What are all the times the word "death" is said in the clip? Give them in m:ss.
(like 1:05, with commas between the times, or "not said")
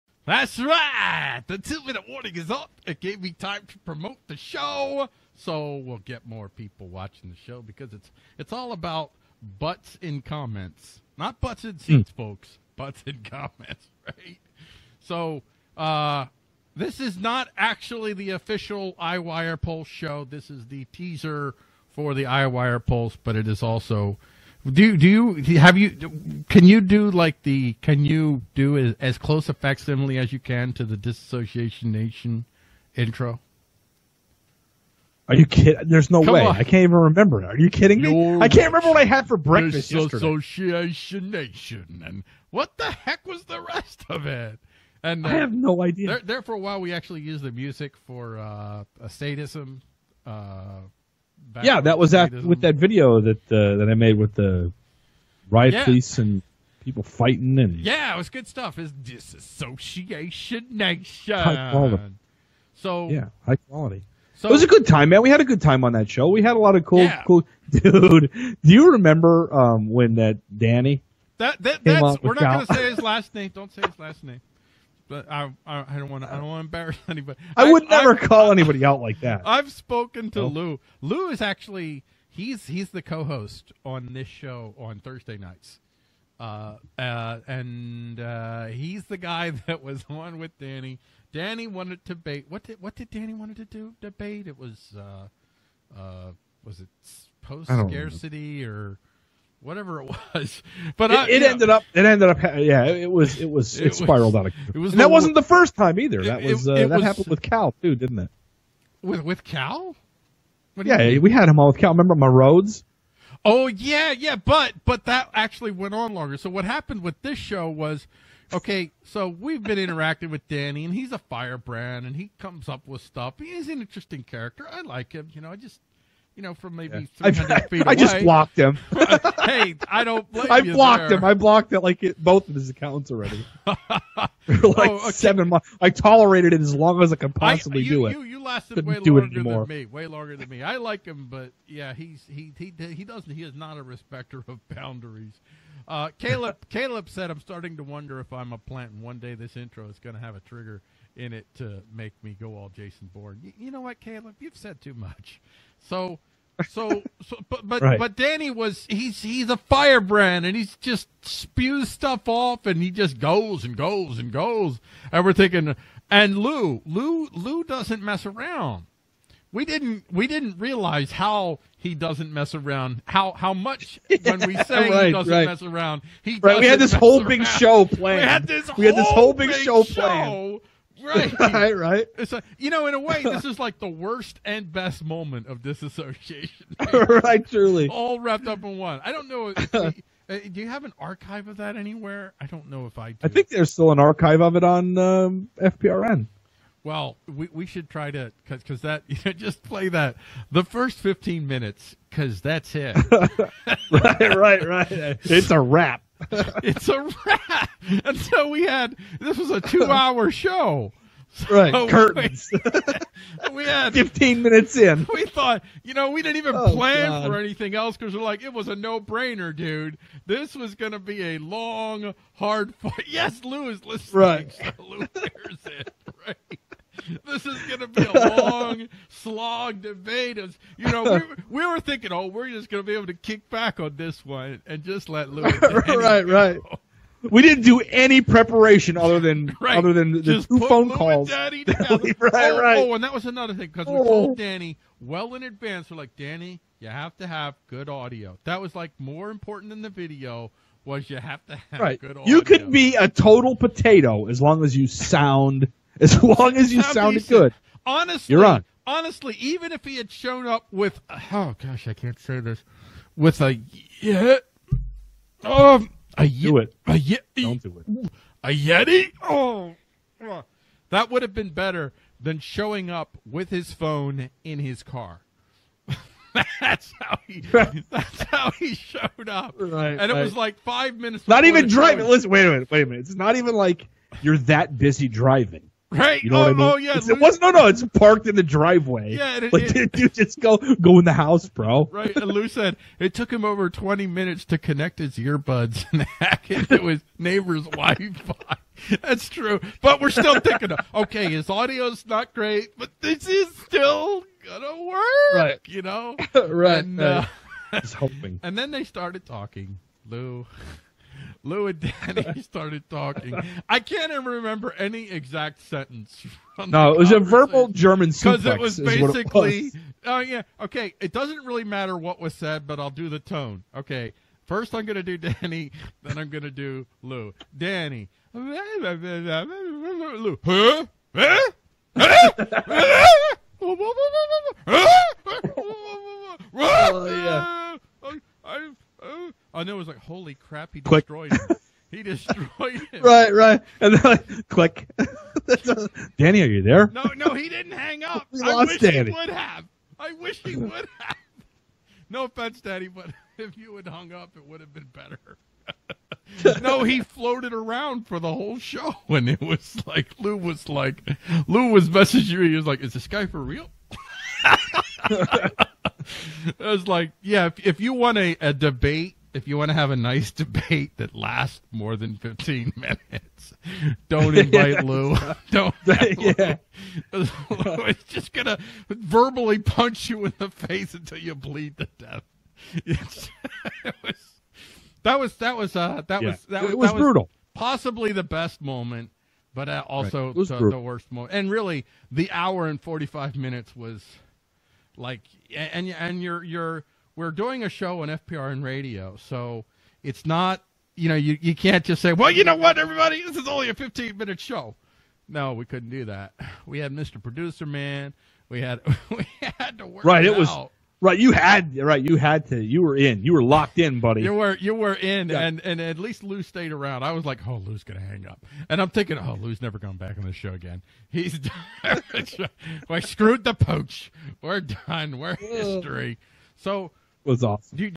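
6:21.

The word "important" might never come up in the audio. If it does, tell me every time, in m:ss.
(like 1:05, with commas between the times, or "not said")
4:09.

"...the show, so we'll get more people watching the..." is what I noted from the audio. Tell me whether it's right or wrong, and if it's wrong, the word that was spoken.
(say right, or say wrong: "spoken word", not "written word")
right.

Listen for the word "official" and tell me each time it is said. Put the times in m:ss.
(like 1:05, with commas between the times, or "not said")
0:18.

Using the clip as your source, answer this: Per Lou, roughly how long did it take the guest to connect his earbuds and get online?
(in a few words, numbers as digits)
over 20 minutes.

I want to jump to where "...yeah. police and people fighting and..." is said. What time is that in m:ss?
0:55.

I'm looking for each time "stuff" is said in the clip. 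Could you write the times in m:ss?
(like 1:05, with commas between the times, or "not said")
0:58, 2:03, 2:41.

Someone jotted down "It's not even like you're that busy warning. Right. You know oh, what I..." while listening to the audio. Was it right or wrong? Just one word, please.
wrong.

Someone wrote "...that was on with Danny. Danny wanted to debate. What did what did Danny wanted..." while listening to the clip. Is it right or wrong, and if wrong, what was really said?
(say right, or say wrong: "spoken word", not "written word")
right.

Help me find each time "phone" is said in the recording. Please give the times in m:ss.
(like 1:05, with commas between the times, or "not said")
4:00, 4:33.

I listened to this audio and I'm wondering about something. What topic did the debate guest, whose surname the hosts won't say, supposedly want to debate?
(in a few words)
post scarcity.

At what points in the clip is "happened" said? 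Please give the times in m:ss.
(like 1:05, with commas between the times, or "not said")
1:47, 1:56.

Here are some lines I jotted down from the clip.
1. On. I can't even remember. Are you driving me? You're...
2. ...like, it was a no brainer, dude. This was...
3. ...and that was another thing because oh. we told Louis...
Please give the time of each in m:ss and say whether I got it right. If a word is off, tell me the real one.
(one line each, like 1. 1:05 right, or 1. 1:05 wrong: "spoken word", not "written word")
1. 0:36 wrong: "kidding", not "driving"
2. 3:38 right
3. 4:02 wrong: "Danny", not "Louis".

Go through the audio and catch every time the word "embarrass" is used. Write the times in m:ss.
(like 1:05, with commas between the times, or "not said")
1:16.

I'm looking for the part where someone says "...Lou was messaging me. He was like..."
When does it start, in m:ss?
6:01.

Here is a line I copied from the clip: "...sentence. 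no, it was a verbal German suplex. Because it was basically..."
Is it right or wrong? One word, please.
right.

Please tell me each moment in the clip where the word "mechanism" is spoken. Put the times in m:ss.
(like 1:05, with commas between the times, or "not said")
not said.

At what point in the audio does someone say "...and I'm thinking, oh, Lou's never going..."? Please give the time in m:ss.
6:58.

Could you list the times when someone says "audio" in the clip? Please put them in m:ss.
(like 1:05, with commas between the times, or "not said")
4:07, 4:12, 5:01.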